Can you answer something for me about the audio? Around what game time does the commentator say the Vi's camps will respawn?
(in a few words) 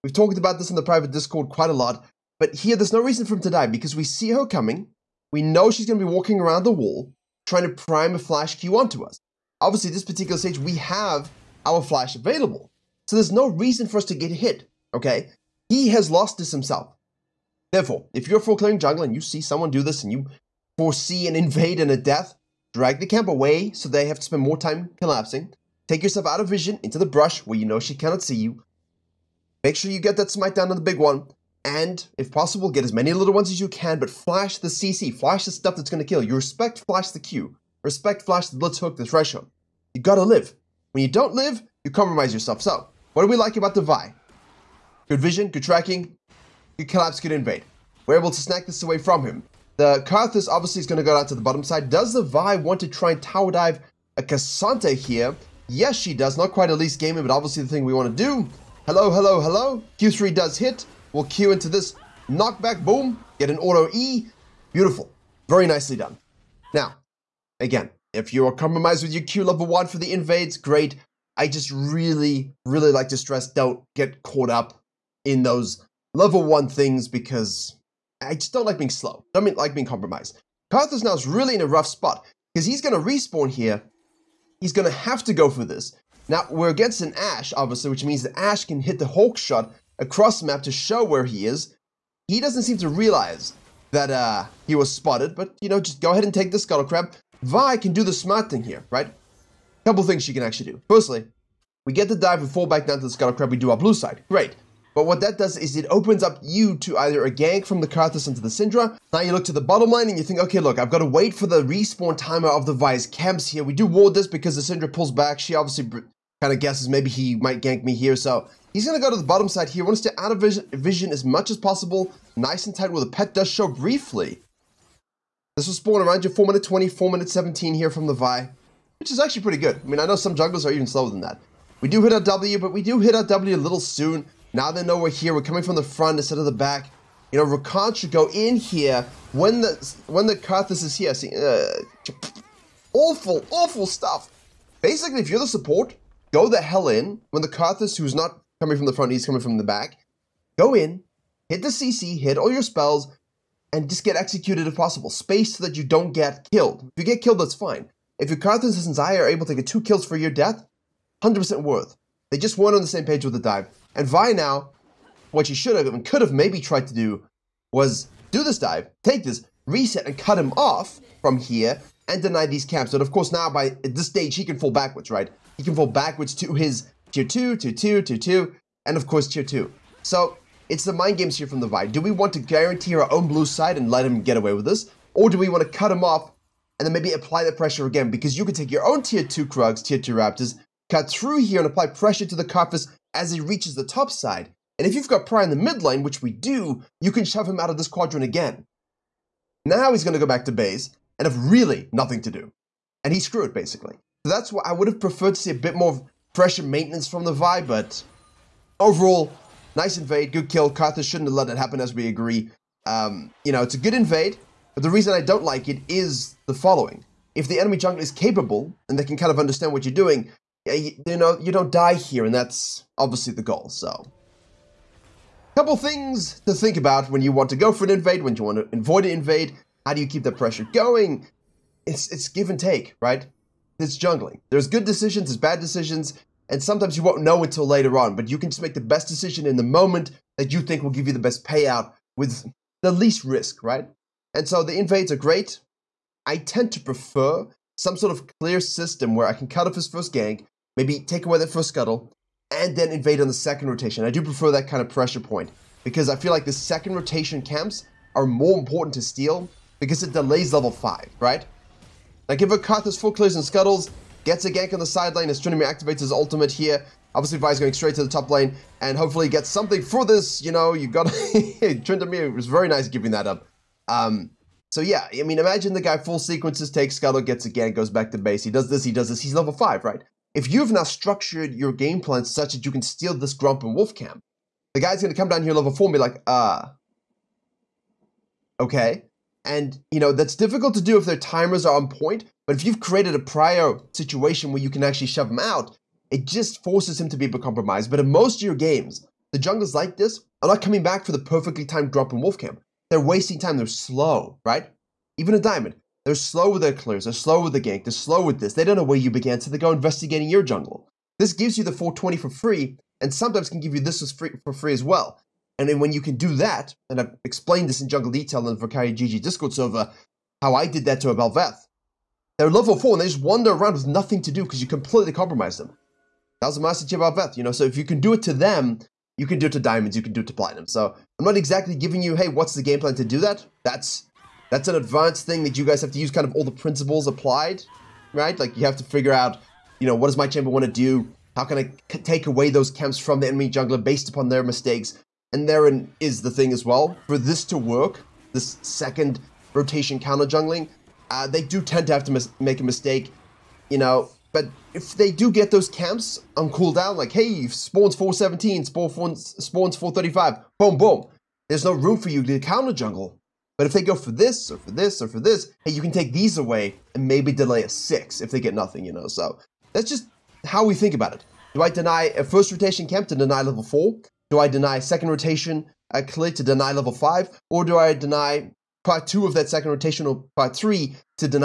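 4:20.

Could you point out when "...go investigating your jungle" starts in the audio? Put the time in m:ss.
5:09.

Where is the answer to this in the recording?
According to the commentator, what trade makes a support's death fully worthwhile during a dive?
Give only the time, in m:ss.
2:39.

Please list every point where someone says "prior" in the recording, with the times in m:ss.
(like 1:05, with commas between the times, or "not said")
4:53.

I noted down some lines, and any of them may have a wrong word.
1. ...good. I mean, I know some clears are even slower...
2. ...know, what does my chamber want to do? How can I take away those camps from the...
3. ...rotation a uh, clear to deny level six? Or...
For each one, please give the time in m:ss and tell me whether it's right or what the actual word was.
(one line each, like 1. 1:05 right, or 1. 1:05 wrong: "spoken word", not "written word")
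1. 2:09 wrong: "junglers", not "clears"
2. 5:39 right
3. 6:15 wrong: "five", not "six".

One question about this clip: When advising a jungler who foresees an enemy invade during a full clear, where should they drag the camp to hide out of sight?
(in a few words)
Into the brush.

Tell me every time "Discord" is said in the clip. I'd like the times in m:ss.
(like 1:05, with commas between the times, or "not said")
0:01, 5:19.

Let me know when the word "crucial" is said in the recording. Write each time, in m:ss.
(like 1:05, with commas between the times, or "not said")
not said.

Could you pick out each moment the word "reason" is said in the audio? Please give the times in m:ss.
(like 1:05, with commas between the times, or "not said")
0:02, 0:13, 3:34.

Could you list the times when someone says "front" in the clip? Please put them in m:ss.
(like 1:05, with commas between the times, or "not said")
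2:15, 2:28.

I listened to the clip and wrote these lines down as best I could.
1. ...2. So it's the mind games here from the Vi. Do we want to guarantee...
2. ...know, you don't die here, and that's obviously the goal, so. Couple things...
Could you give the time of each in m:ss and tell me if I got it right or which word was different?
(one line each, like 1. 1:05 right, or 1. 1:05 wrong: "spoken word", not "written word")
1. 2:59 right
2. 3:41 right.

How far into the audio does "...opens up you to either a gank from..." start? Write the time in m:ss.
1:45.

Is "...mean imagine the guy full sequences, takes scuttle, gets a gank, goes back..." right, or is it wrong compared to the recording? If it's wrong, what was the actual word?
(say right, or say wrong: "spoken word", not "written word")
right.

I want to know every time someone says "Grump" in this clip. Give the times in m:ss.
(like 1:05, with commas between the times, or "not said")
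4:43, 5:01.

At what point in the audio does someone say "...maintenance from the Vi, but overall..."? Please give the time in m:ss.
3:26.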